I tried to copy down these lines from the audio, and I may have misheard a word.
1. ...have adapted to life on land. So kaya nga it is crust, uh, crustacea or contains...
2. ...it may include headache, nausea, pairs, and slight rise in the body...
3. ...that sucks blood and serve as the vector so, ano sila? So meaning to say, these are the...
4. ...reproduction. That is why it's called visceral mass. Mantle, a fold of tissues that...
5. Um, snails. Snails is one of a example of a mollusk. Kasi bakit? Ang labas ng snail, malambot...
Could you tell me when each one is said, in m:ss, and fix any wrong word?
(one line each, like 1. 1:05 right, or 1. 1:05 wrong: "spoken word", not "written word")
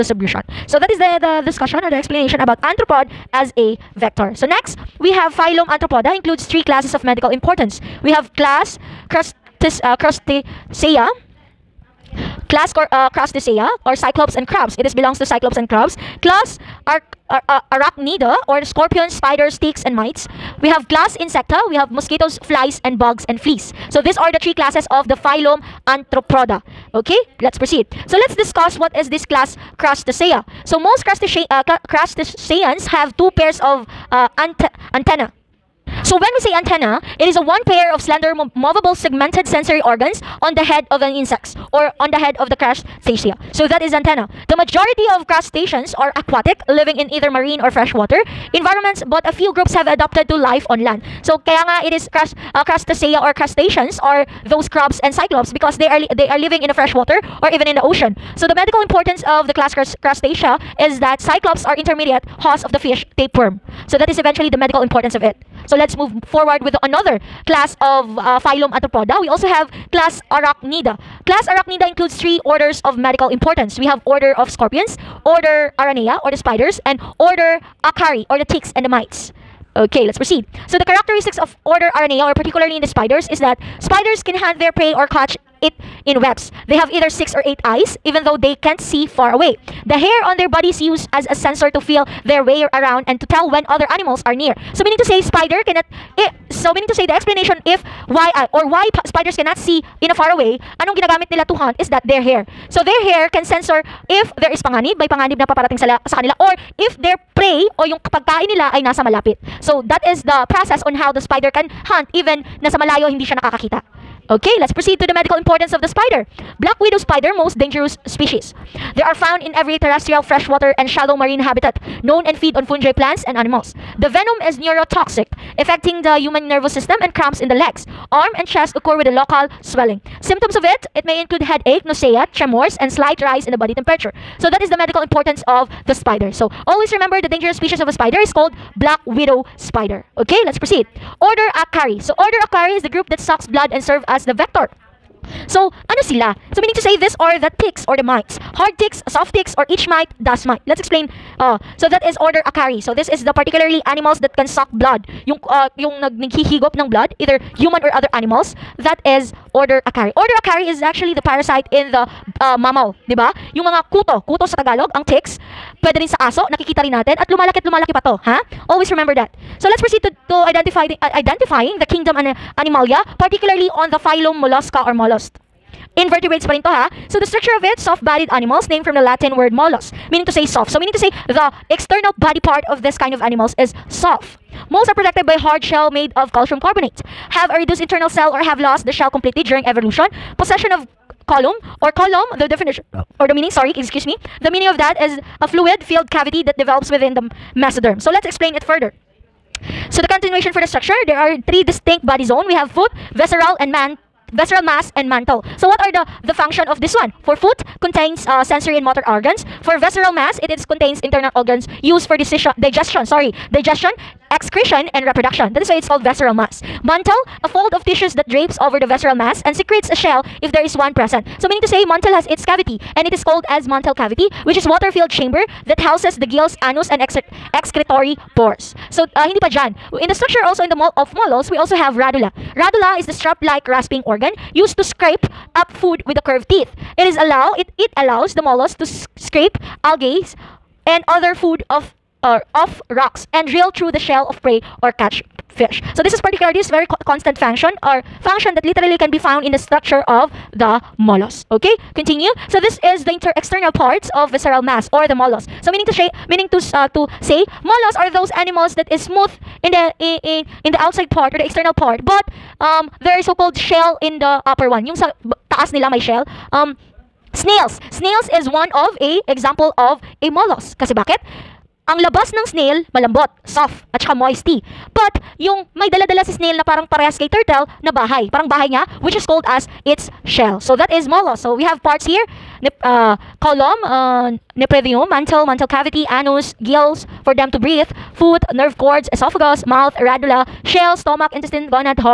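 1. 0:49 wrong: "crustaceans", not "contains"
2. 2:10 wrong: "tremors", not "pairs"
3. 2:23 right
4. 3:35 right
5. 4:26 right.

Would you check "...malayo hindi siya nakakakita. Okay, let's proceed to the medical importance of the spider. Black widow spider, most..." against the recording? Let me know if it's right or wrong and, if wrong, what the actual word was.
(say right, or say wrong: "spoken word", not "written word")
right.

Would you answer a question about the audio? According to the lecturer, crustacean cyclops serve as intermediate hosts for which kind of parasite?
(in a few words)
fish tapeworm.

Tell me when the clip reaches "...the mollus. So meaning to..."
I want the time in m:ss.
4:15.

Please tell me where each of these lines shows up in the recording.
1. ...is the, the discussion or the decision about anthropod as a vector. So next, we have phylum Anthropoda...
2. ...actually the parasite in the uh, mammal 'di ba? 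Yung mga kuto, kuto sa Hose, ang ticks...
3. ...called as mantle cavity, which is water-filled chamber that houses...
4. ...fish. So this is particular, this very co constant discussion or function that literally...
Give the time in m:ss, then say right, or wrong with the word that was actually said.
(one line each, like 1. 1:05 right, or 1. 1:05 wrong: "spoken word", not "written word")
1. 0:00 wrong: "explanation", not "decision"
2. 2:40 wrong: "Tagalog", not "Hose"
3. 3:43 right
4. 4:05 wrong: "function", not "discussion".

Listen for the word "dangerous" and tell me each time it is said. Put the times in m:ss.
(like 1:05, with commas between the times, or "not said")
1:57, 2:17.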